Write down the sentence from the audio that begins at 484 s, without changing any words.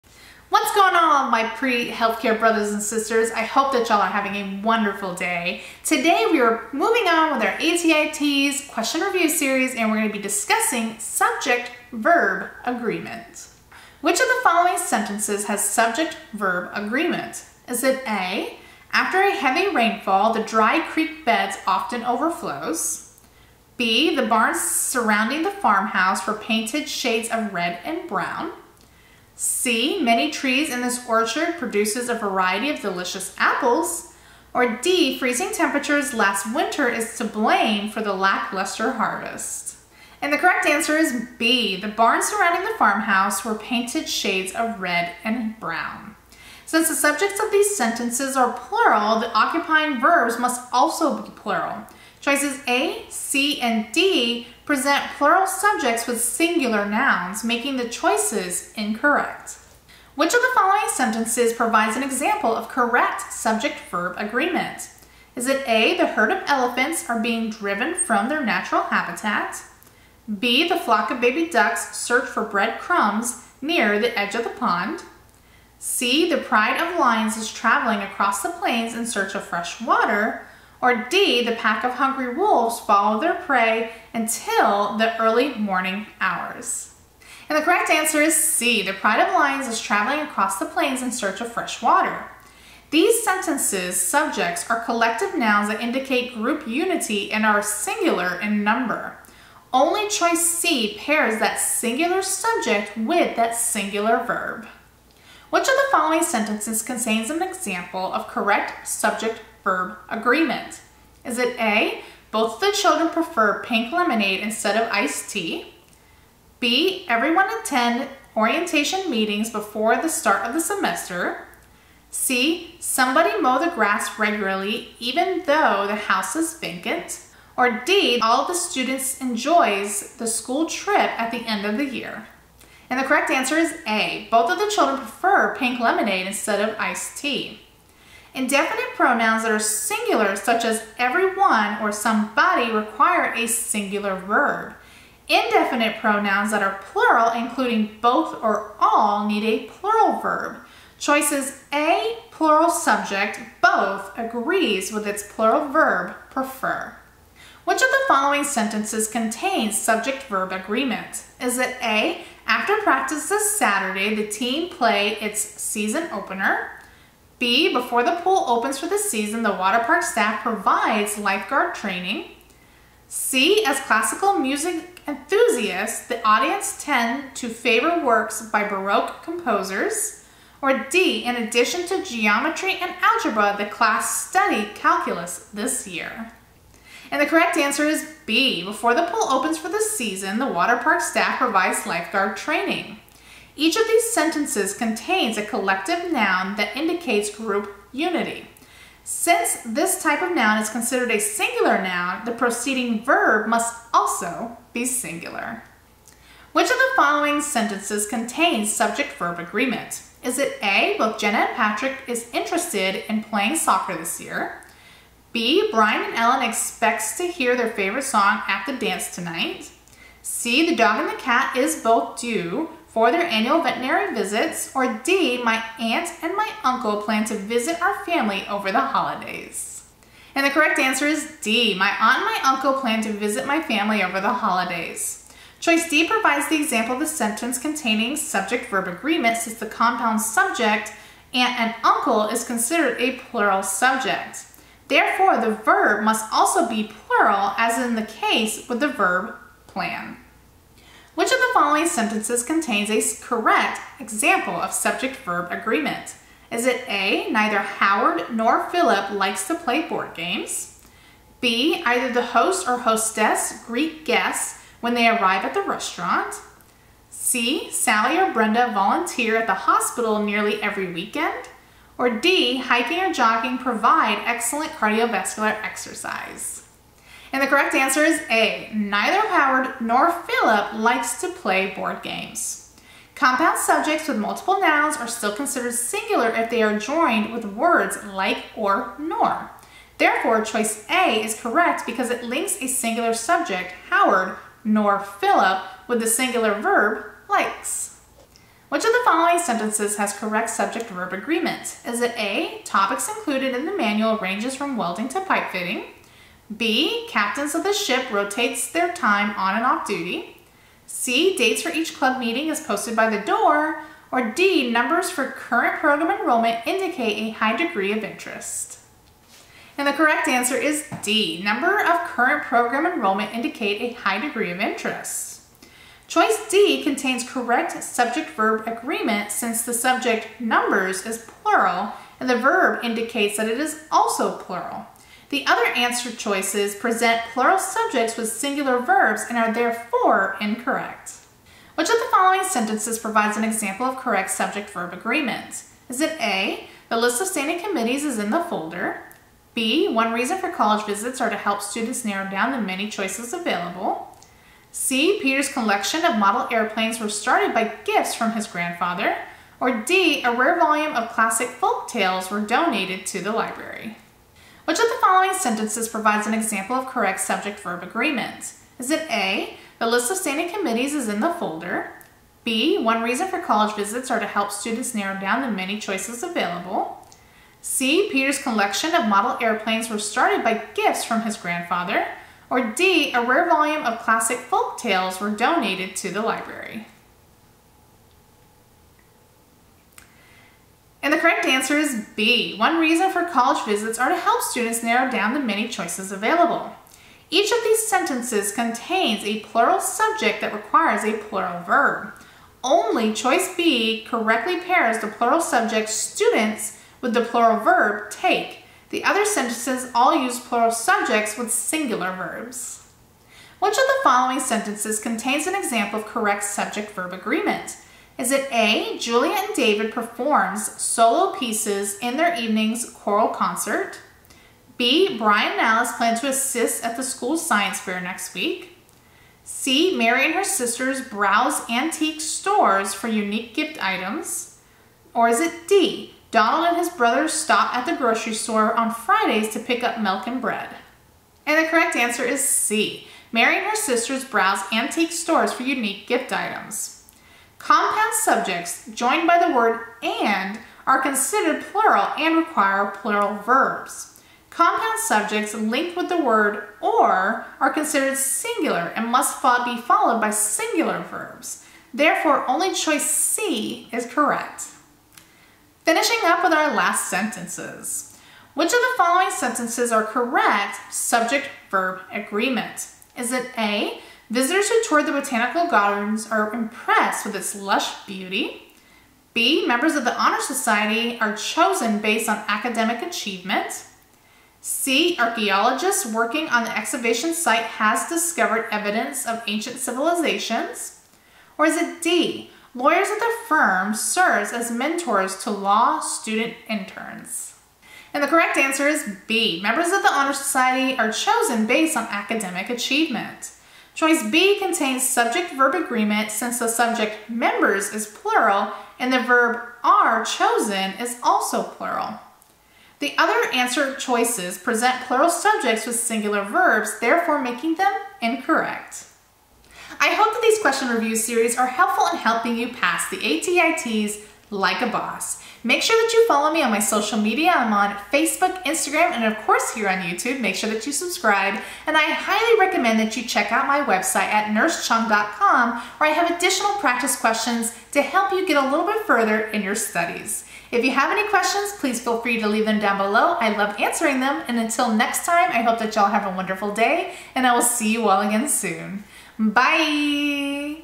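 C, archaeologists working on the excavation site has discovered evidence of ancient civilizations.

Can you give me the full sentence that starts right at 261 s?
B, either the host or hostess greet guests when they arrive at the restaurant?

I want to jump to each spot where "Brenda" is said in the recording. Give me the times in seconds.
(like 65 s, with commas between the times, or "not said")
268 s.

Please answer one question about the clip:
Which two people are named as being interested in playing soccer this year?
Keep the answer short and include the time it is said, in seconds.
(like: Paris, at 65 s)
Jenna and Patrick, at 211 s.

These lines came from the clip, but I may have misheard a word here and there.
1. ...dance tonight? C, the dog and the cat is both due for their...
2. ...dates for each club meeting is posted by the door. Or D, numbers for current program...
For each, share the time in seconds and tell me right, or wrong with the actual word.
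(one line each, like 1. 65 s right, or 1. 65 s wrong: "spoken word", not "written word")
1. 218 s right
2. 311 s right.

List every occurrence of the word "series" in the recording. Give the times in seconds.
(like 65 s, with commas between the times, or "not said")
9 s, 521 s.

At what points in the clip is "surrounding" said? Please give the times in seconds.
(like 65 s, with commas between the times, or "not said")
24 s, 42 s.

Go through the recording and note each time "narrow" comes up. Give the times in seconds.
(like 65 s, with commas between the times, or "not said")
352 s, 374 s, 394 s.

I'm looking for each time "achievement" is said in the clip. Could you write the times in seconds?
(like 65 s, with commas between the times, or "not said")
483 s, 502 s.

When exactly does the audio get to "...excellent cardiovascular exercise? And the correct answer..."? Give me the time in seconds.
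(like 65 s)
274 s.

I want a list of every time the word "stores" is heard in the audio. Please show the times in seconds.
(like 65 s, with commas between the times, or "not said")
432 s, 438 s, 445 s.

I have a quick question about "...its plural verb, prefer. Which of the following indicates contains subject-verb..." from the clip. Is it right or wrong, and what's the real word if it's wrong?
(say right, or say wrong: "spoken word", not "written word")
wrong: "sentences", not "indicates".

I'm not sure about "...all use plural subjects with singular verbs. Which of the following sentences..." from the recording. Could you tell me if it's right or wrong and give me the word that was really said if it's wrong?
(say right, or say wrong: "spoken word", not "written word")
right.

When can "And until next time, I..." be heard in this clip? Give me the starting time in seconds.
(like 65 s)
544 s.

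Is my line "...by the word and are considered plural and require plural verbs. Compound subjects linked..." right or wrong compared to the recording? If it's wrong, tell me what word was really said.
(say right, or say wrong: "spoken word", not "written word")
right.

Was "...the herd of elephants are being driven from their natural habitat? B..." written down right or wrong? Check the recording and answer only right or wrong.
right.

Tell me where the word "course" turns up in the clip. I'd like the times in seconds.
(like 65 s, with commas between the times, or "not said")
529 s.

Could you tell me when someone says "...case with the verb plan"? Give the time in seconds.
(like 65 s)
248 s.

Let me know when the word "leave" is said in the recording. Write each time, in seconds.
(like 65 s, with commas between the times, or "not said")
542 s.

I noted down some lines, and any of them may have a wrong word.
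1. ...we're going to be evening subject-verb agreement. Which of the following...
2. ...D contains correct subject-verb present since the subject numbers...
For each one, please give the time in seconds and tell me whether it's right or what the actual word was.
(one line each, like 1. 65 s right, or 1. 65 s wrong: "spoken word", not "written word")
1. 9 s wrong: "discussing", not "evening"
2. 326 s wrong: "agreement", not "present".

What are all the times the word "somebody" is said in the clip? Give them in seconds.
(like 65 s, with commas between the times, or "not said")
122 s, 141 s.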